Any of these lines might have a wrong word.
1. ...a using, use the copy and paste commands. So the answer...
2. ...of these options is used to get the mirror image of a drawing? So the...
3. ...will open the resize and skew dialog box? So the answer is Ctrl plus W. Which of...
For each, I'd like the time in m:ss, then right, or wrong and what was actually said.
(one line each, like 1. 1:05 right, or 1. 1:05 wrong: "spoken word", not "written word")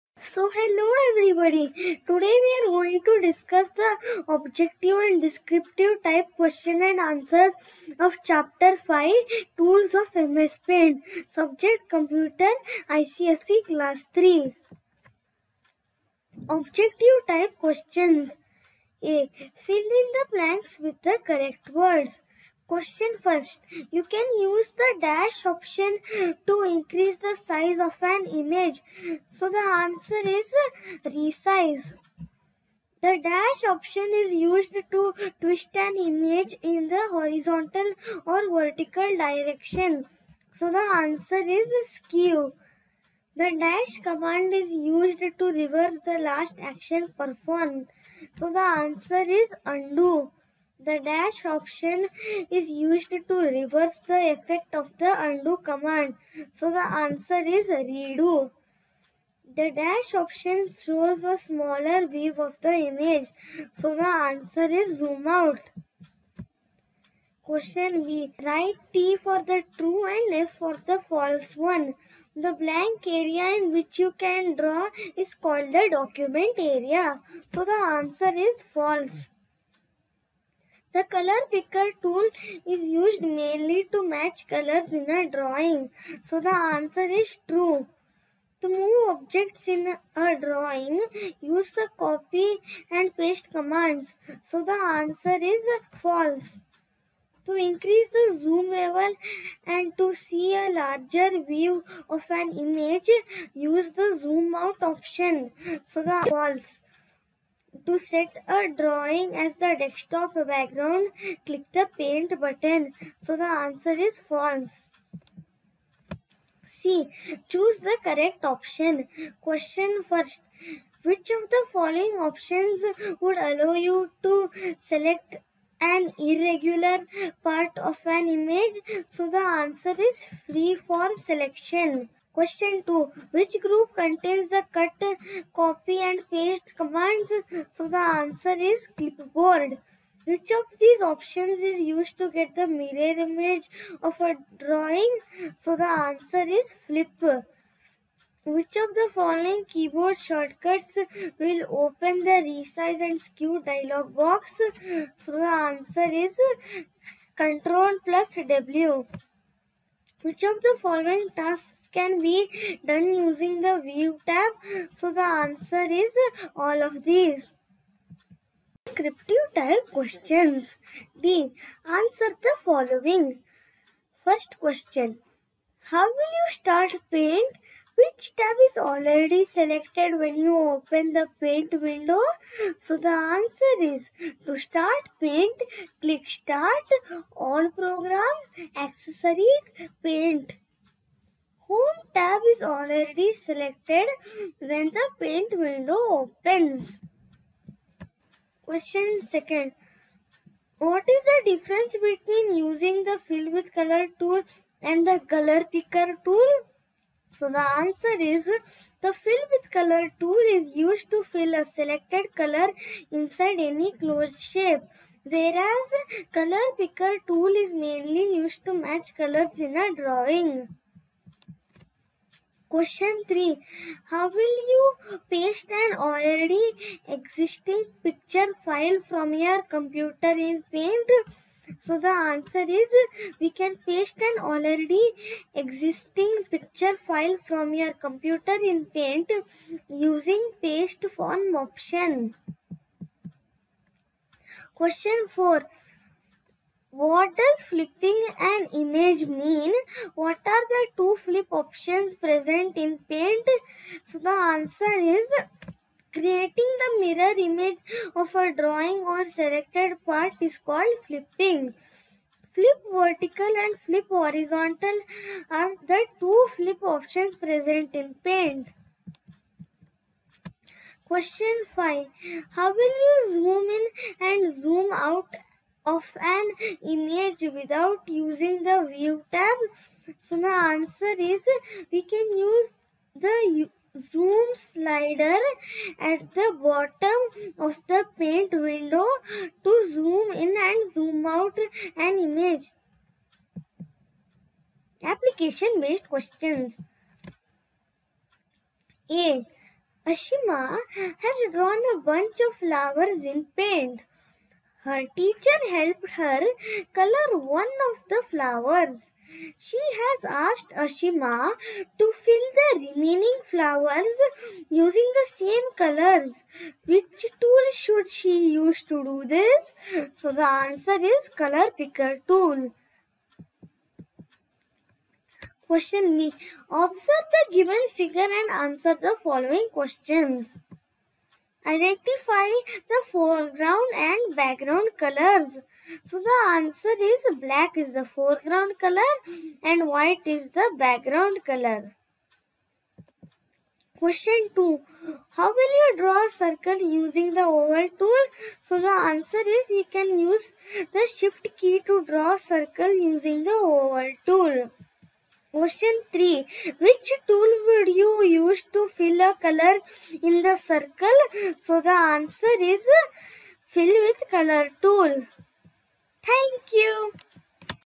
1. 1:30 wrong: "drawing", not "using"
2. 2:20 right
3. 2:31 right.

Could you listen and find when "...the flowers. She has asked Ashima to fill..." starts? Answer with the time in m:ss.
5:08.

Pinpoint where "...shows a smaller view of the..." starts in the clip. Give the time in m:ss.
1:00.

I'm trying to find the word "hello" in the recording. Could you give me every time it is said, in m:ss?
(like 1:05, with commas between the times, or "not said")
0:00.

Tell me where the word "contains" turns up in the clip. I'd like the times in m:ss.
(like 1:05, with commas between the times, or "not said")
2:13.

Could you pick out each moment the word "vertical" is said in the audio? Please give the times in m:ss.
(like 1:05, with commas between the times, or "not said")
0:38, 4:22.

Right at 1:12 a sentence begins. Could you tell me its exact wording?
The blank area in which you can draw is called the document area.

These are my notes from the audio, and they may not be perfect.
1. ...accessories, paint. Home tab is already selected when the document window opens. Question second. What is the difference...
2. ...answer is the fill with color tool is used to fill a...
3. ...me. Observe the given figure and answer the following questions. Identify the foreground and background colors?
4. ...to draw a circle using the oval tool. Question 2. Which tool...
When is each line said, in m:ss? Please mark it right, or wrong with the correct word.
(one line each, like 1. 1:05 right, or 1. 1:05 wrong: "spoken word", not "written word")
1. 3:08 wrong: "paint", not "document"
2. 3:27 right
3. 5:26 right
4. 5:51 wrong: "3", not "2".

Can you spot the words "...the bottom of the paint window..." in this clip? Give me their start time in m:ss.
4:46.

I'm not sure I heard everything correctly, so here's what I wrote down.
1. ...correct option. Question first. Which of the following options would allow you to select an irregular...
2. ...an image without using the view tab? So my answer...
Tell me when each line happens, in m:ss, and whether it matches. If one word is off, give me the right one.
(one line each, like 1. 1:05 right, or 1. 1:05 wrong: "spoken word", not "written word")
1. 1:58 right
2. 4:36 right.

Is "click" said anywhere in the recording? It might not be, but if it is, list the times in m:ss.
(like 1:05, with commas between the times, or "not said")
1:51, 3:06.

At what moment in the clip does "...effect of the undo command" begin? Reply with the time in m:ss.
0:54.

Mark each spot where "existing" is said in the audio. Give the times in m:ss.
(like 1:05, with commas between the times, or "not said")
3:47, 3:55.